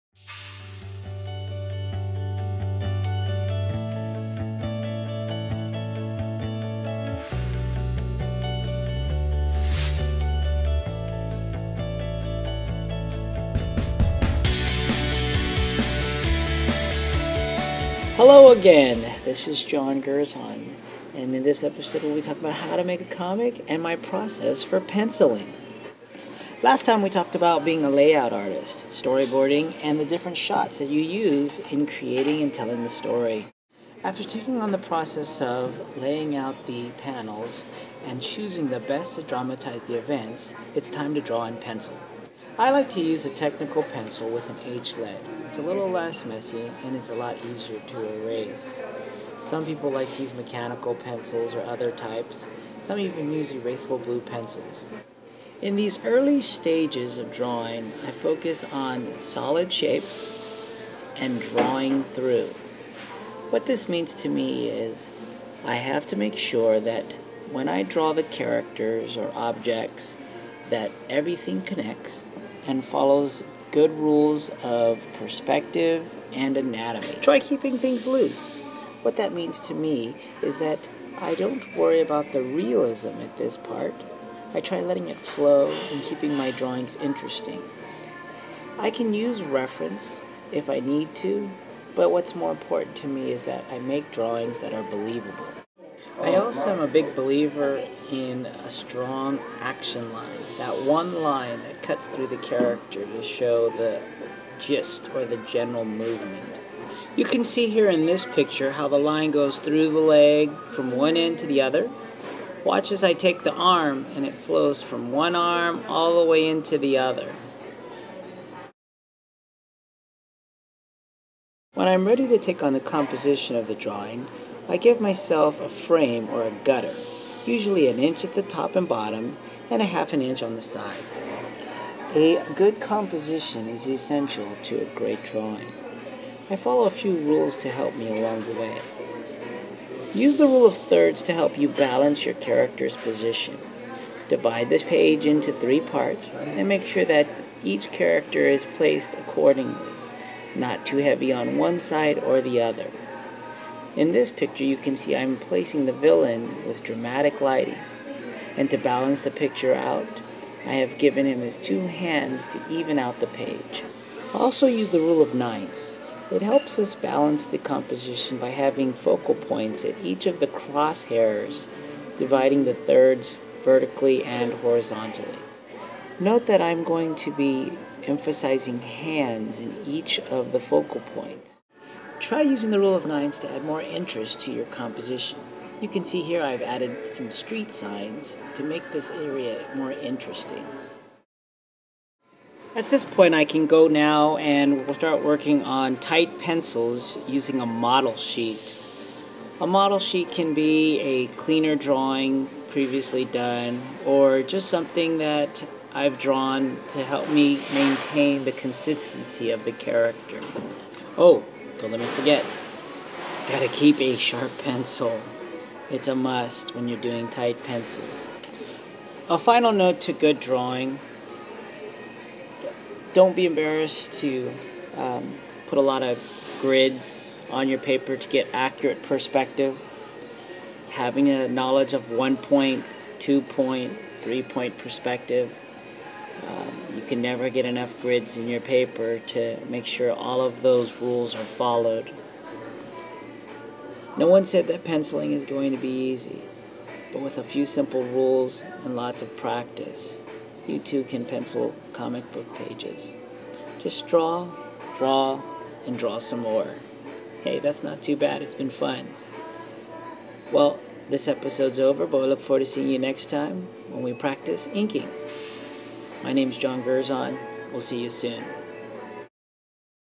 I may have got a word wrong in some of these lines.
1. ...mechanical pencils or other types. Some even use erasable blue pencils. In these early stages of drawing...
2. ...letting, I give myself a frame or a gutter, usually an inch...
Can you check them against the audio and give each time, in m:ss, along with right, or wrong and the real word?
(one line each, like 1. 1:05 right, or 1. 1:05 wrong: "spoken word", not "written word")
1. 0:50 right
2. 2:03 wrong: "drawing", not "letting".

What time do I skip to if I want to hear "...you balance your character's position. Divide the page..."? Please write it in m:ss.
2:21.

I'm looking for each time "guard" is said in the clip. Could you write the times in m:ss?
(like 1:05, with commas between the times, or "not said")
not said.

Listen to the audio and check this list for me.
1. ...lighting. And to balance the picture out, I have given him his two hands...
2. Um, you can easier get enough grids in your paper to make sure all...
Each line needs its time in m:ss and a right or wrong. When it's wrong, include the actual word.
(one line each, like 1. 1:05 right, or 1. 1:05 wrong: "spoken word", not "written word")
1. 2:37 right
2. 3:56 wrong: "never", not "easier".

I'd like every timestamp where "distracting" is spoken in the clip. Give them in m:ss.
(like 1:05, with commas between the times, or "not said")
not said.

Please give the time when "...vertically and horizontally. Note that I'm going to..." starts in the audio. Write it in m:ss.
2:53.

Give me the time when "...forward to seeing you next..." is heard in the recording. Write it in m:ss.
4:22.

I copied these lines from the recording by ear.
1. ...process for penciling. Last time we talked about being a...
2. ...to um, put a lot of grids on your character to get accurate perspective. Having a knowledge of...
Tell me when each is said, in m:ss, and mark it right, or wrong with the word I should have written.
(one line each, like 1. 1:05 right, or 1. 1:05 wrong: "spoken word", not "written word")
1. 0:23 right
2. 3:44 wrong: "paper", not "character".